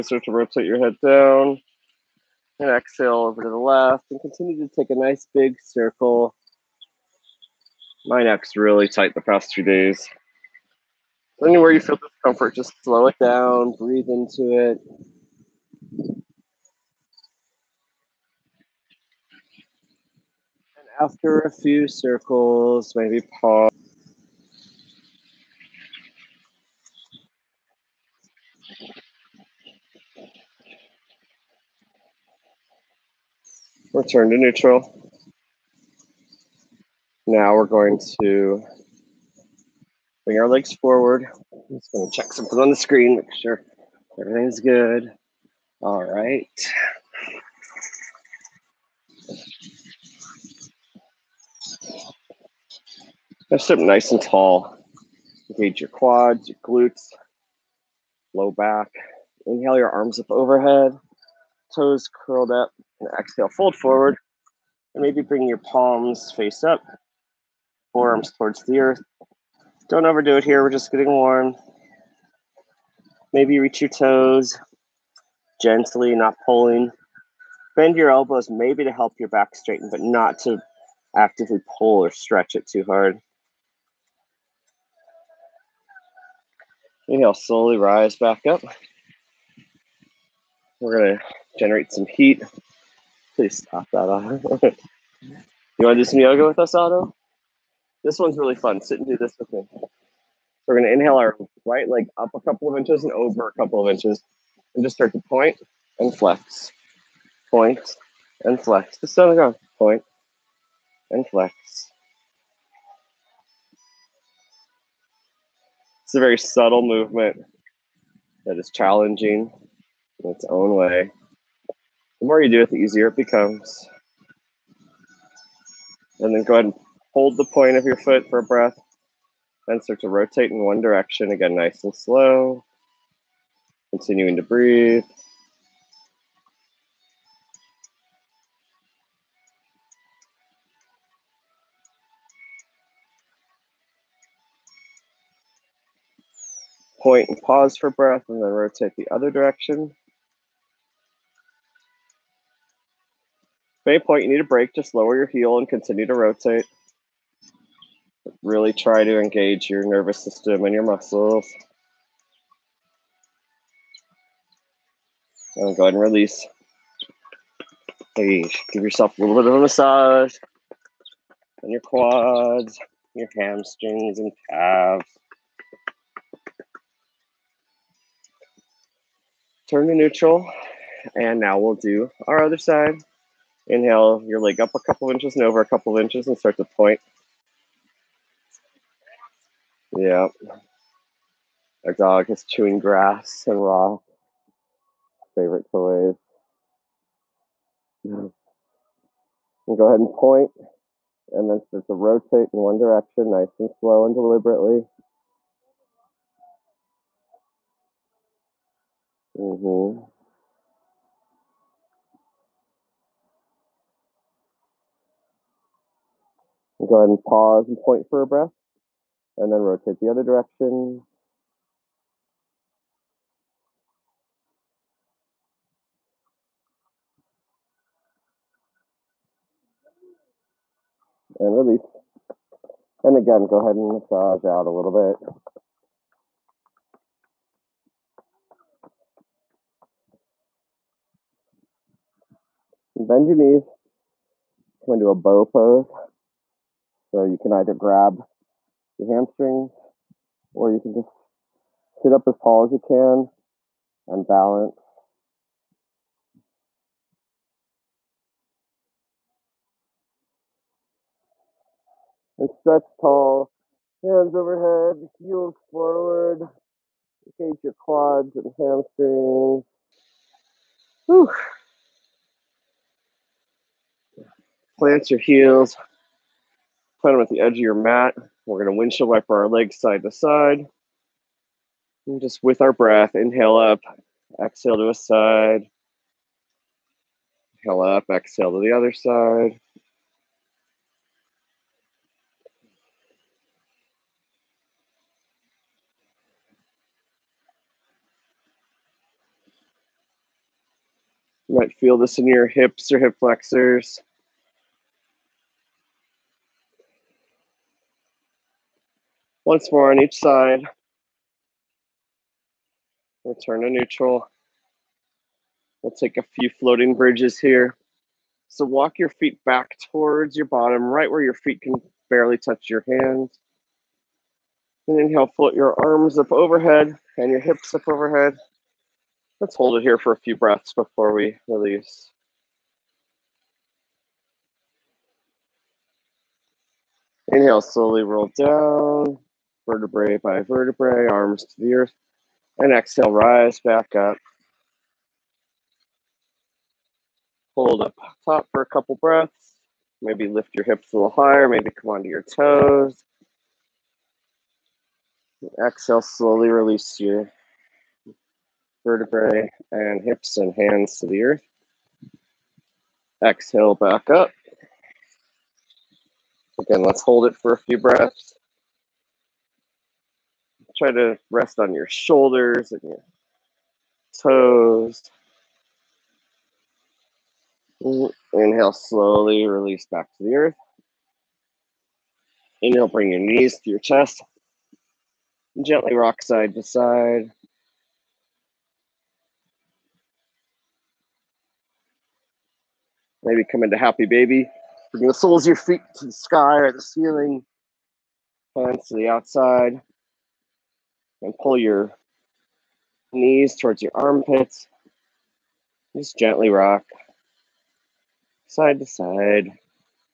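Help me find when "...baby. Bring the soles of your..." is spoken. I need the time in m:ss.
6:34.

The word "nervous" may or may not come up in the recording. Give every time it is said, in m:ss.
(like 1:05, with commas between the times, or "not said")
2:39.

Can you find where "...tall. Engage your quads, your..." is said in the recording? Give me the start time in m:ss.
0:54.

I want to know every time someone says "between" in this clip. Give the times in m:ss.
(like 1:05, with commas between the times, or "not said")
not said.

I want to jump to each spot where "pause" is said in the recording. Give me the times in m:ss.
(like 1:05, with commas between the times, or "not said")
0:23, 2:27, 3:37.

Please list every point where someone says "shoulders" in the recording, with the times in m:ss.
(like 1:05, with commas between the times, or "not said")
6:11.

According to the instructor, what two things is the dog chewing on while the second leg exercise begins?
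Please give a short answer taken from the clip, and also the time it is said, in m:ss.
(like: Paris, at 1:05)
grass and rocks, at 3:12.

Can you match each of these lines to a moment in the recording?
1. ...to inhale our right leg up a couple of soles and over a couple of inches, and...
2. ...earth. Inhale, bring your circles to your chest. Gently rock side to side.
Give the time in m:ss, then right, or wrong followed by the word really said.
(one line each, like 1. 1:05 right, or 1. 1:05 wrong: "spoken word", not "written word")
1. 1:40 wrong: "inches", not "soles"
2. 6:20 wrong: "knees", not "circles".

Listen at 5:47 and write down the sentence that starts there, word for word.
Hold up top for a couple breaths.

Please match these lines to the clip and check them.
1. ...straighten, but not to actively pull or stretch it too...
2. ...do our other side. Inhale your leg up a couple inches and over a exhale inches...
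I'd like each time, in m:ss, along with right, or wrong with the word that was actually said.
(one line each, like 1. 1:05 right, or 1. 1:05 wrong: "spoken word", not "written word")
1. 1:19 right
2. 3:01 wrong: "couple", not "exhale".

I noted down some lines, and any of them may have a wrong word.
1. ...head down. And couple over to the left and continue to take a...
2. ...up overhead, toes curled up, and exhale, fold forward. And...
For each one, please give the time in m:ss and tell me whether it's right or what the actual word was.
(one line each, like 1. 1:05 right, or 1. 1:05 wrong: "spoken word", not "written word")
1. 0:00 wrong: "exhale", not "couple"
2. 1:00 right.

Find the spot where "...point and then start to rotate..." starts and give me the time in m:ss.
3:20.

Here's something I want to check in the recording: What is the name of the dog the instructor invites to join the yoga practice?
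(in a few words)
Otto.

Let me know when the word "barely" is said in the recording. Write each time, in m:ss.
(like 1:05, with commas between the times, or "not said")
5:22.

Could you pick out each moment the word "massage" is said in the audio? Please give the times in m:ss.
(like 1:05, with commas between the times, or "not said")
2:49, 3:53.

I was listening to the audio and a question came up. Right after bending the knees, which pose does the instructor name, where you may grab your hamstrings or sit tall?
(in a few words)
bow pose.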